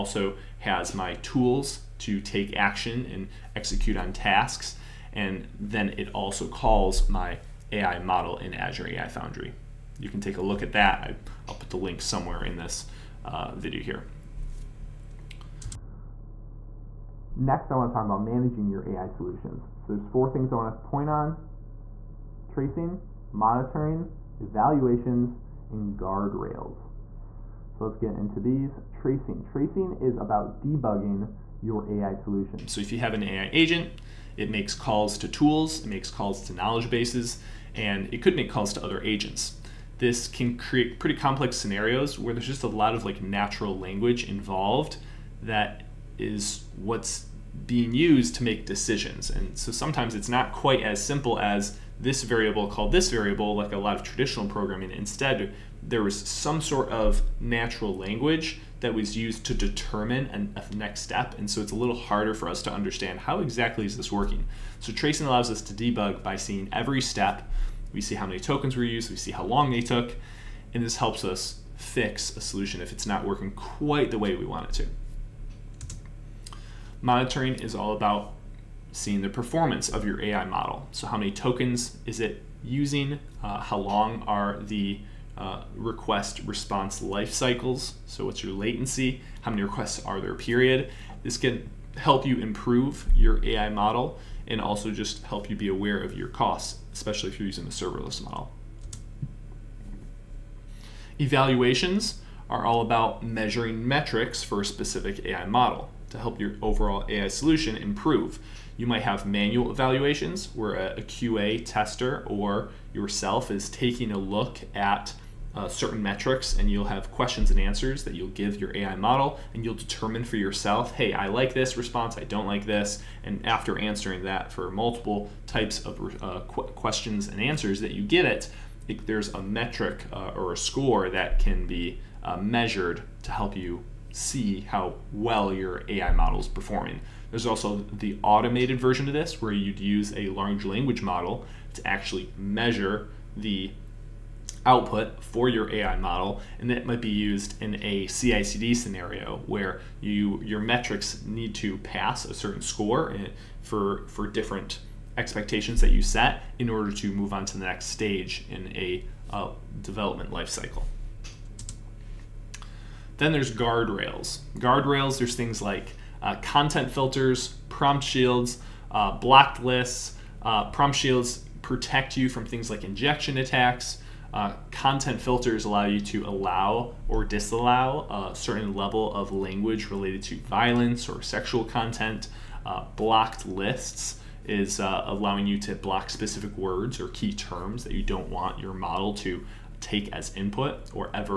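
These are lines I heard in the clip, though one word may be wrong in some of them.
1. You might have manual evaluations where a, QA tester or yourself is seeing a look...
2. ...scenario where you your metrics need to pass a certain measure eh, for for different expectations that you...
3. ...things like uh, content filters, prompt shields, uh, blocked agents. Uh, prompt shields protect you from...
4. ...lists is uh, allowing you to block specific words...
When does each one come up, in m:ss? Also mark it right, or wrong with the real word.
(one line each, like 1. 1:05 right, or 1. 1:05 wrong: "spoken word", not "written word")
1. 1:48 wrong: "taking", not "seeing"
2. 2:28 wrong: "score", not "measure"
3. 2:45 wrong: "lists", not "agents"
4. 3:03 right.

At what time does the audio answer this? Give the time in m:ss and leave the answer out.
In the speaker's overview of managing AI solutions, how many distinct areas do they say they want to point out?
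0:20.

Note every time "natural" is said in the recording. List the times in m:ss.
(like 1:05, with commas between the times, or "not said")
0:43, 0:57.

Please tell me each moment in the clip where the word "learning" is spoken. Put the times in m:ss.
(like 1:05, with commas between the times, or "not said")
not said.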